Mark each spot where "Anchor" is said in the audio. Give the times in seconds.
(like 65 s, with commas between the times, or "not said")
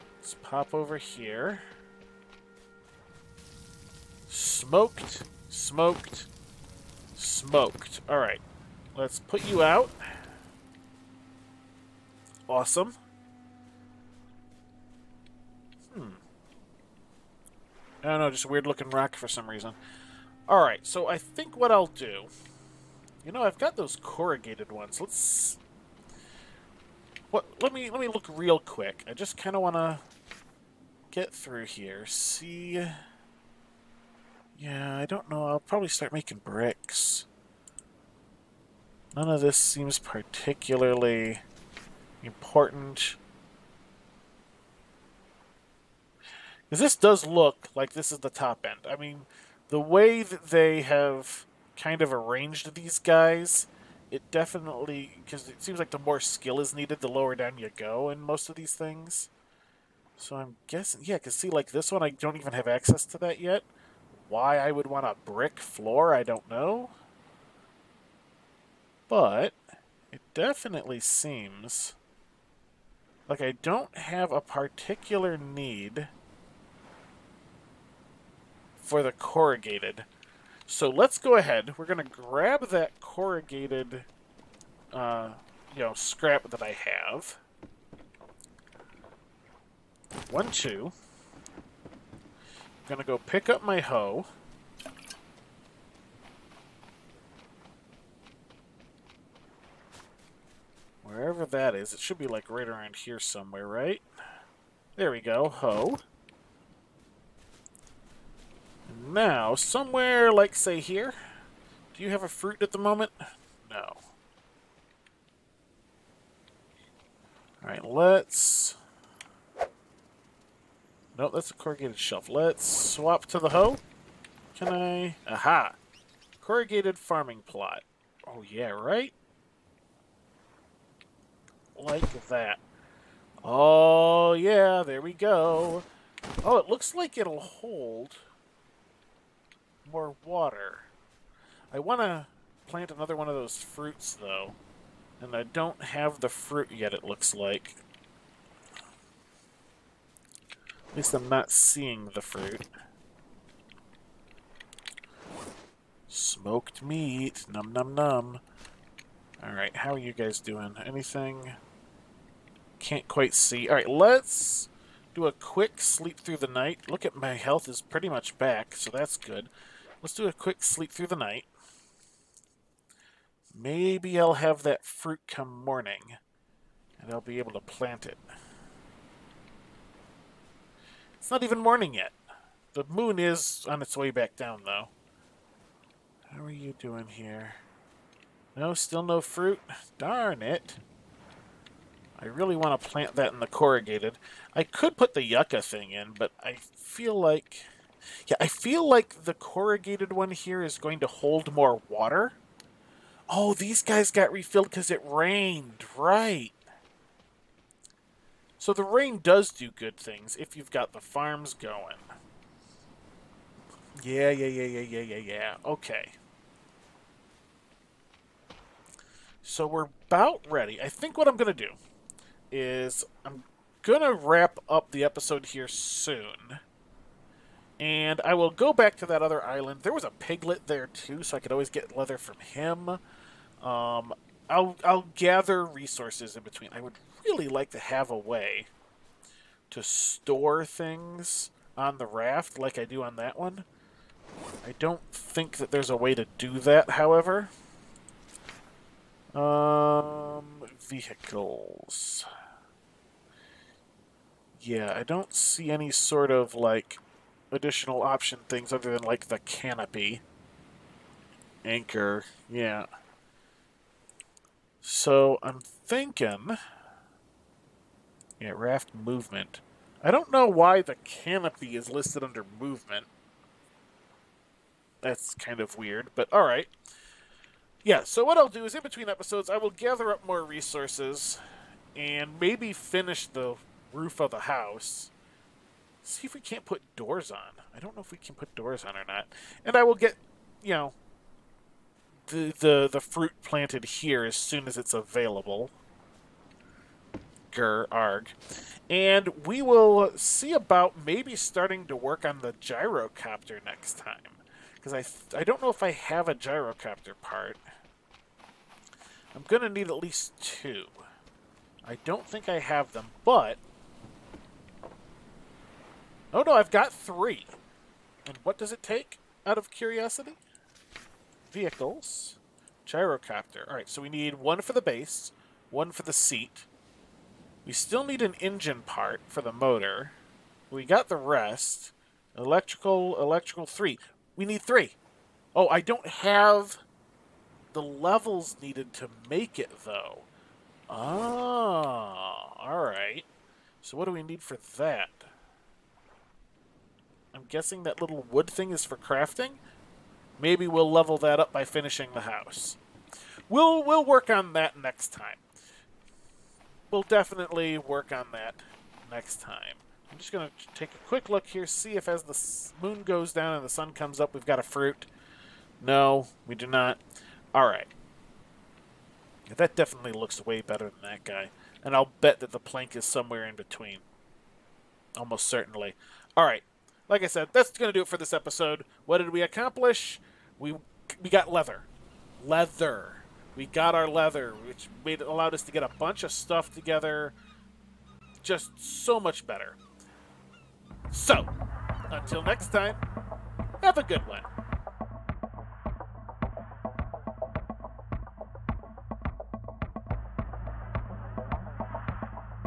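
261 s.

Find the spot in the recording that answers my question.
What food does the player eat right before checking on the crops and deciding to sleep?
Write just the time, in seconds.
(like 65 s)
156 s.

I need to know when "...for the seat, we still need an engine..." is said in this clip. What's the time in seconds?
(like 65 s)
325 s.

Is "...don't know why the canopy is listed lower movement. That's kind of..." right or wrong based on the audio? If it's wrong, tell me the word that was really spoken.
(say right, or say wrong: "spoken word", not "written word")
wrong: "under", not "lower".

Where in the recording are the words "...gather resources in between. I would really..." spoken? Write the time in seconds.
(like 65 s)
235 s.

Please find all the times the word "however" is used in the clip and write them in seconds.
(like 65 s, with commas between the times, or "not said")
246 s.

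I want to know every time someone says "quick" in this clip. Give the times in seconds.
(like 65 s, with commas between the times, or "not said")
28 s, 165 s, 170 s, 361 s.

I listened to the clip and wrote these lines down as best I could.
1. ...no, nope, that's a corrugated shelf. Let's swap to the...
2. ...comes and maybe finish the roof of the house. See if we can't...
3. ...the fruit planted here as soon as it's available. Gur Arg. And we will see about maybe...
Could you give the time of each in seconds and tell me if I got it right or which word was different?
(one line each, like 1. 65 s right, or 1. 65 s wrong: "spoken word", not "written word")
1. 121 s right
2. 280 s wrong: "resources", not "comes"
3. 292 s right.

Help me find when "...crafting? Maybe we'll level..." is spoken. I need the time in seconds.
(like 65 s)
348 s.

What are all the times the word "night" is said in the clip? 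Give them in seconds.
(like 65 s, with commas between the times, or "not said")
166 s, 171 s.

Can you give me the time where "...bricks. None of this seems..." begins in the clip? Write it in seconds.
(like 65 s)
36 s.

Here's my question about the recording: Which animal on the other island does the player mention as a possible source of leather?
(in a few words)
Piglet.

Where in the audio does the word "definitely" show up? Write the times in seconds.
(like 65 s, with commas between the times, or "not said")
54 s, 70 s, 357 s, 369 s.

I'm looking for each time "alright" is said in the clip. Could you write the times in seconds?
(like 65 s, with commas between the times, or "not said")
8 s, 20 s, 117 s, 159 s, 163 s, 276 s, 323 s, 342 s.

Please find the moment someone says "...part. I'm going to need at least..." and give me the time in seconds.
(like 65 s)
307 s.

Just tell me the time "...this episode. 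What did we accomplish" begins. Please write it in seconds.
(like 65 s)
378 s.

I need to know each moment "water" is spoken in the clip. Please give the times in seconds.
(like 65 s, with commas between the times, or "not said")
140 s, 201 s.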